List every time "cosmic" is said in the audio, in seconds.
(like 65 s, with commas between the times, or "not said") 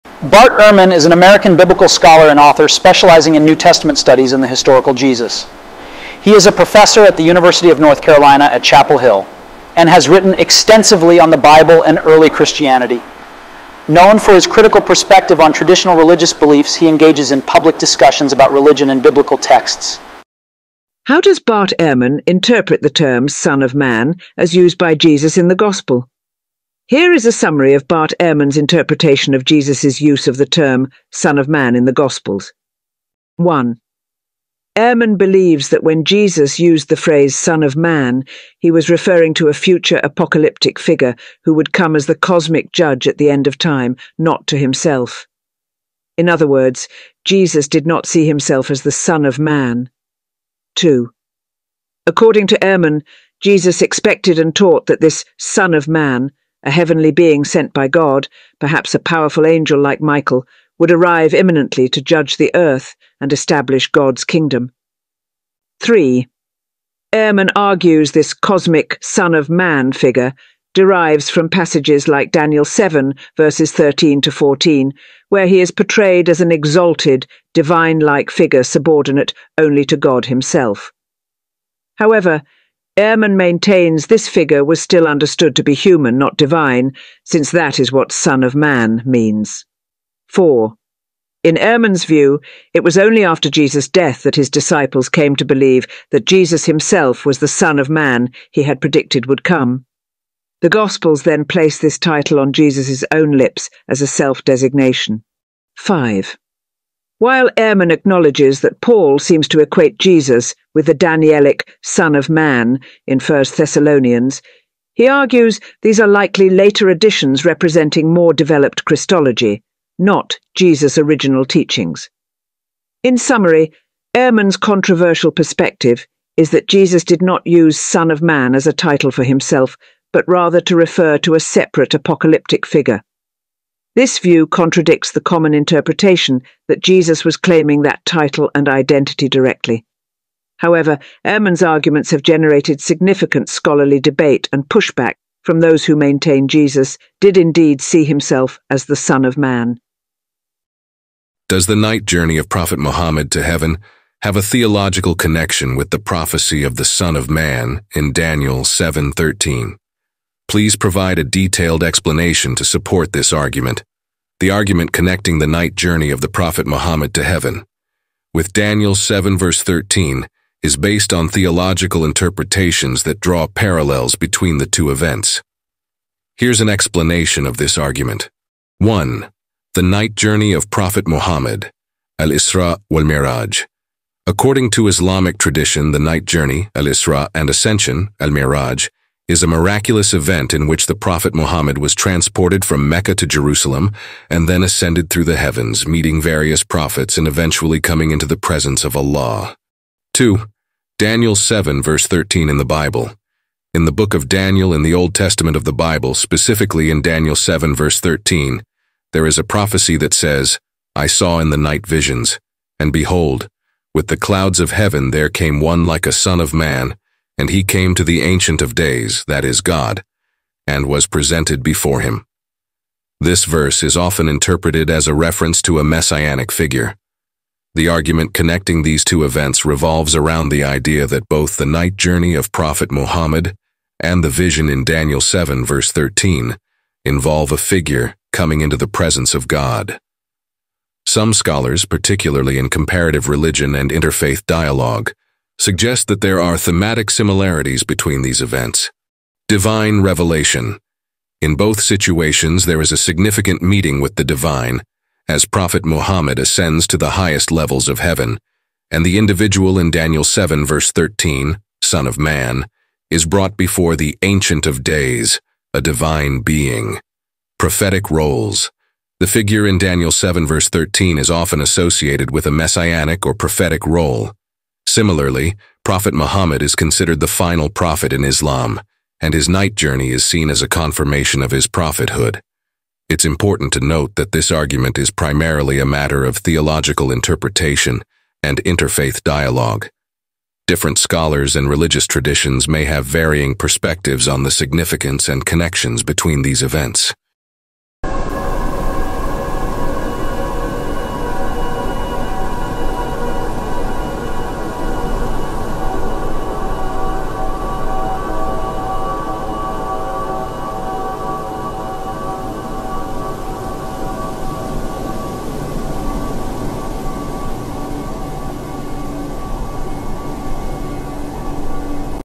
42 s, 68 s.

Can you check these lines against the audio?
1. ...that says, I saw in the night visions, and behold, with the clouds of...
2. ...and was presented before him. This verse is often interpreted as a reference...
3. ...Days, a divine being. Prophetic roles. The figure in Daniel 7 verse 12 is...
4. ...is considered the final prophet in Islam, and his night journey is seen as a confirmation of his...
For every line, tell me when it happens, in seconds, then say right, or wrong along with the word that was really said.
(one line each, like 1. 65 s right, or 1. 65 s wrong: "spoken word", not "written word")
1. 209 s right
2. 220 s right
3. 264 s wrong: "13", not "12"
4. 276 s right.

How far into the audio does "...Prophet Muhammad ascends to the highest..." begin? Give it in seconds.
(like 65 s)
255 s.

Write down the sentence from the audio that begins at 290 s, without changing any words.
Different scholars and religious traditions may have varying perspectives on the significance and connections between these events.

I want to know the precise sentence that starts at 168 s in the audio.
With Daniel 7 verse 13 is based on theological interpretations that draw parallels between the two events.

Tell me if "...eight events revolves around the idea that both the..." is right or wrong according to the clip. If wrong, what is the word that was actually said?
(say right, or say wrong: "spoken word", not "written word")
wrong: "two", not "eight".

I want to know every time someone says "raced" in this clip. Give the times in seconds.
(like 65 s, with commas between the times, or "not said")
not said.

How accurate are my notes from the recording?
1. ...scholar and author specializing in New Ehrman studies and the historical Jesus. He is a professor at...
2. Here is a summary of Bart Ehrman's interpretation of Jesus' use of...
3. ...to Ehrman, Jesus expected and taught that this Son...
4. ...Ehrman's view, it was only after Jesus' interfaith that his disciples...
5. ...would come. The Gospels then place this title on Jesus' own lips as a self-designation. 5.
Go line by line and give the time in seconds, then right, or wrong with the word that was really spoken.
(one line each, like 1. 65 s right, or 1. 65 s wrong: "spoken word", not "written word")
1. 1 s wrong: "Testament", not "Ehrman"
2. 26 s right
3. 52 s right
4. 91 s wrong: "death", not "interfaith"
5. 99 s right.